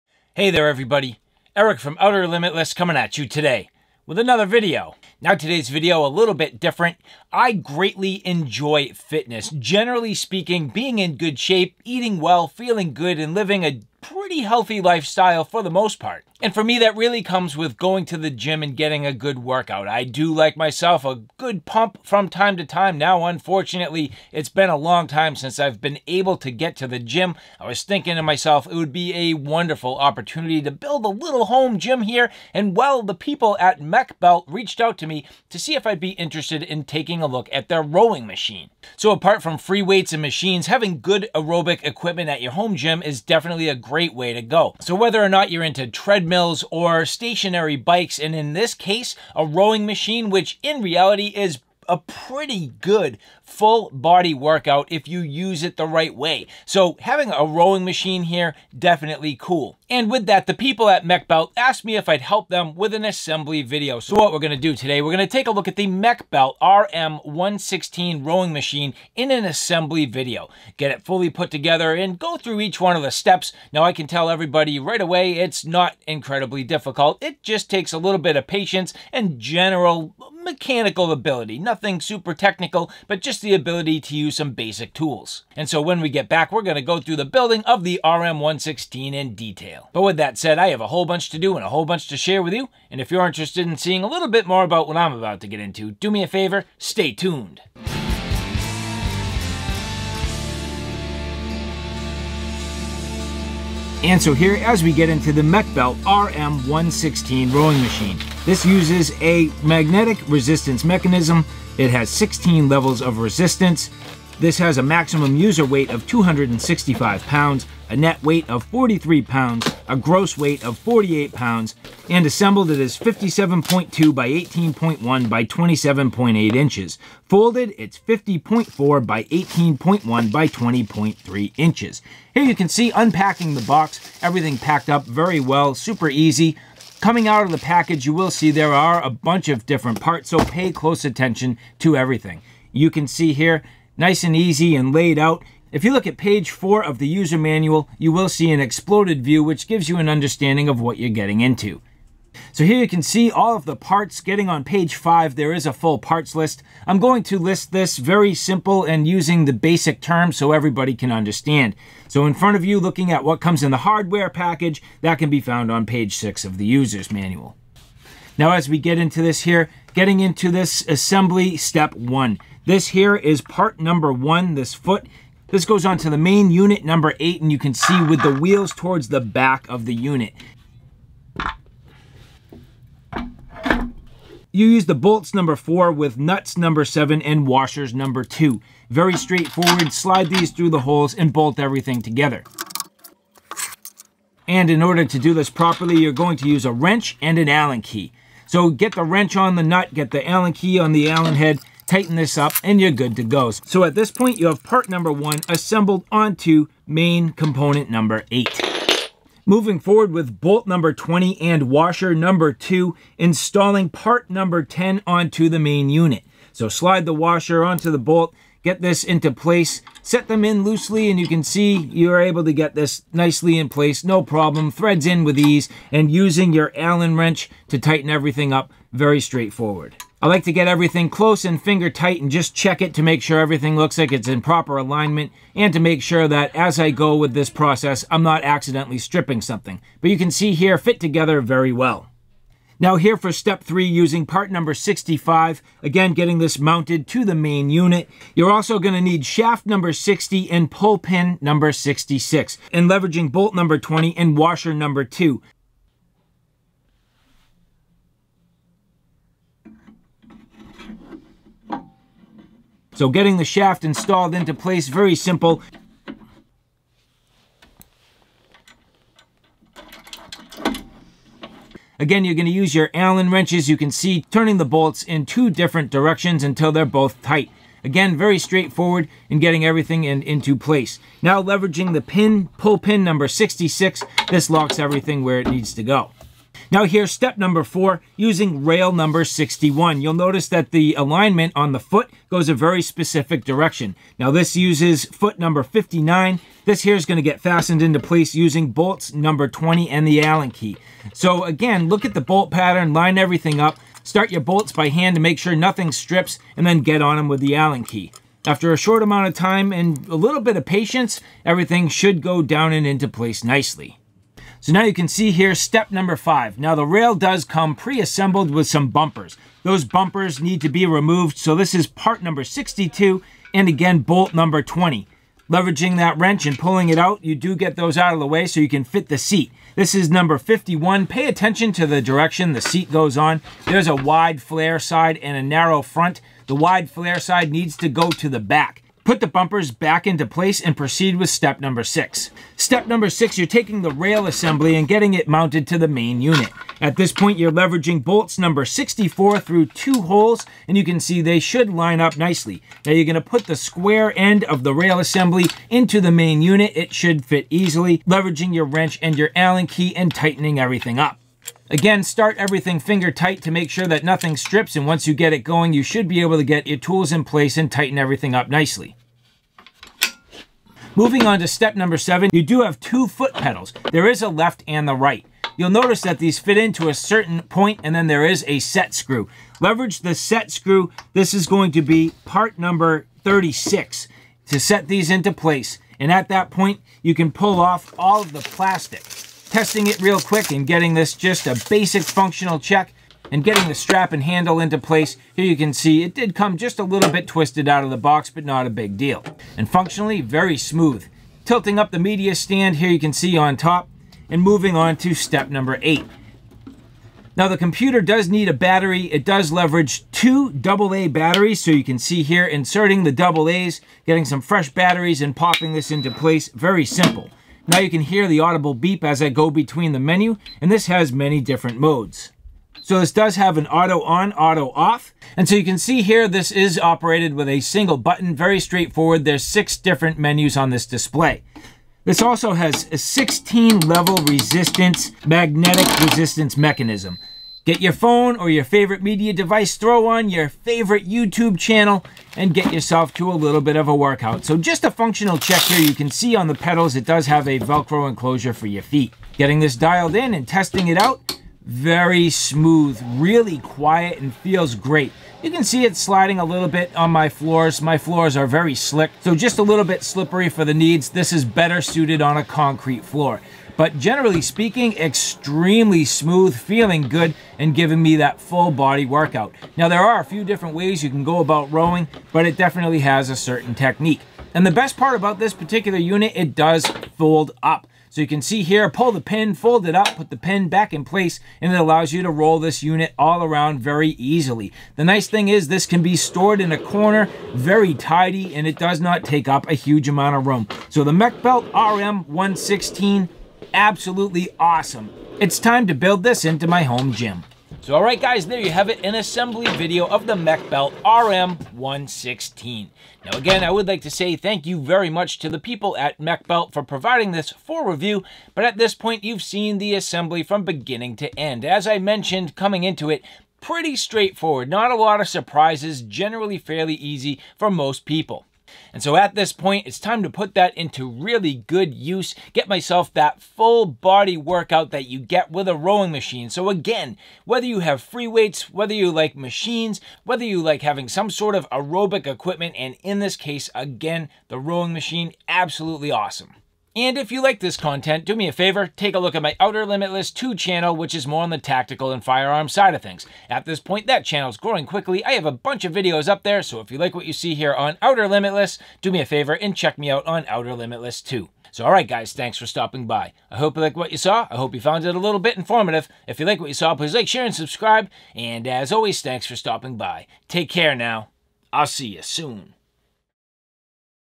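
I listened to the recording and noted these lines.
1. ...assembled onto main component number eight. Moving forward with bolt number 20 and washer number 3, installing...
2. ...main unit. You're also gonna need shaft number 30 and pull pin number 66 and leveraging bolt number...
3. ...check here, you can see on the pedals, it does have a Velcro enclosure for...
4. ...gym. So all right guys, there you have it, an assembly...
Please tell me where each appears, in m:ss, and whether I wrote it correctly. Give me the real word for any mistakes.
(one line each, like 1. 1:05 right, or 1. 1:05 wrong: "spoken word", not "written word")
1. 3:25 wrong: "2", not "3"
2. 4:07 wrong: "60", not "30"
3. 7:25 right
4. 8:17 right.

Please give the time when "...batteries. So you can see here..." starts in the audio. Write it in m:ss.
6:51.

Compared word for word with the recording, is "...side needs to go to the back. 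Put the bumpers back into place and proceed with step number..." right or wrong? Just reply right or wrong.
right.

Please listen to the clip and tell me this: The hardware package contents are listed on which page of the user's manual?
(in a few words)
page 6.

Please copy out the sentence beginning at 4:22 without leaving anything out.
So getting the shaft installed into place, very simple.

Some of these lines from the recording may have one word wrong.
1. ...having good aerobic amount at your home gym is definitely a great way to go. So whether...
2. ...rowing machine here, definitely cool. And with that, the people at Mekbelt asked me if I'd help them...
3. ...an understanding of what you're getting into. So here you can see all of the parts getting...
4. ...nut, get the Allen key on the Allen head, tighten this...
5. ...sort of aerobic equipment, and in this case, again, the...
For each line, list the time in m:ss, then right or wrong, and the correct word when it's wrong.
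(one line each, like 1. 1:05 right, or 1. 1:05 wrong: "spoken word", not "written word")
1. 0:40 wrong: "equipment", not "amount"
2. 0:57 right
3. 2:29 right
4. 3:19 right
5. 8:51 right.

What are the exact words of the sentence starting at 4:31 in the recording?
Again, you're gonna use your Allen wrenches, you can see, turning the bolts in two different directions until they're both tight.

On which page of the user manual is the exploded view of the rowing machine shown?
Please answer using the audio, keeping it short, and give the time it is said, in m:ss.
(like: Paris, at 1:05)
page 4, at 2:26.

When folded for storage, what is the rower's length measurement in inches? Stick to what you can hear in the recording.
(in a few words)
50.4.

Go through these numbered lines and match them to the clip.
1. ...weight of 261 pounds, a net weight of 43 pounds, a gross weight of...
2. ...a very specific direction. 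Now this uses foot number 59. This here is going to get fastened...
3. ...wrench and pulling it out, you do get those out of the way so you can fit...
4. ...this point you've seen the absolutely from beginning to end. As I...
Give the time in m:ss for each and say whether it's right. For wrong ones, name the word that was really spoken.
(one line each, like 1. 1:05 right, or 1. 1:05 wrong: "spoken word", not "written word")
1. 1:55 wrong: "265", not "261"
2. 4:52 right
3. 5:26 right
4. 8:28 wrong: "assembly", not "absolutely".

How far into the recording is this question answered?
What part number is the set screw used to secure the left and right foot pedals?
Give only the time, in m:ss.
6:22.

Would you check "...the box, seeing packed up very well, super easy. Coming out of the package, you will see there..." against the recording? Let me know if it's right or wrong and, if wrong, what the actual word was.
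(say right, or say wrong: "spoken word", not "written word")
wrong: "everything", not "seeing".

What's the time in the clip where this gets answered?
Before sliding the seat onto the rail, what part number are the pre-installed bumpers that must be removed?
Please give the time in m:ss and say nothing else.
5:21.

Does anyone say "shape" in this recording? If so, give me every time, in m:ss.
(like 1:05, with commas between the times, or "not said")
0:11.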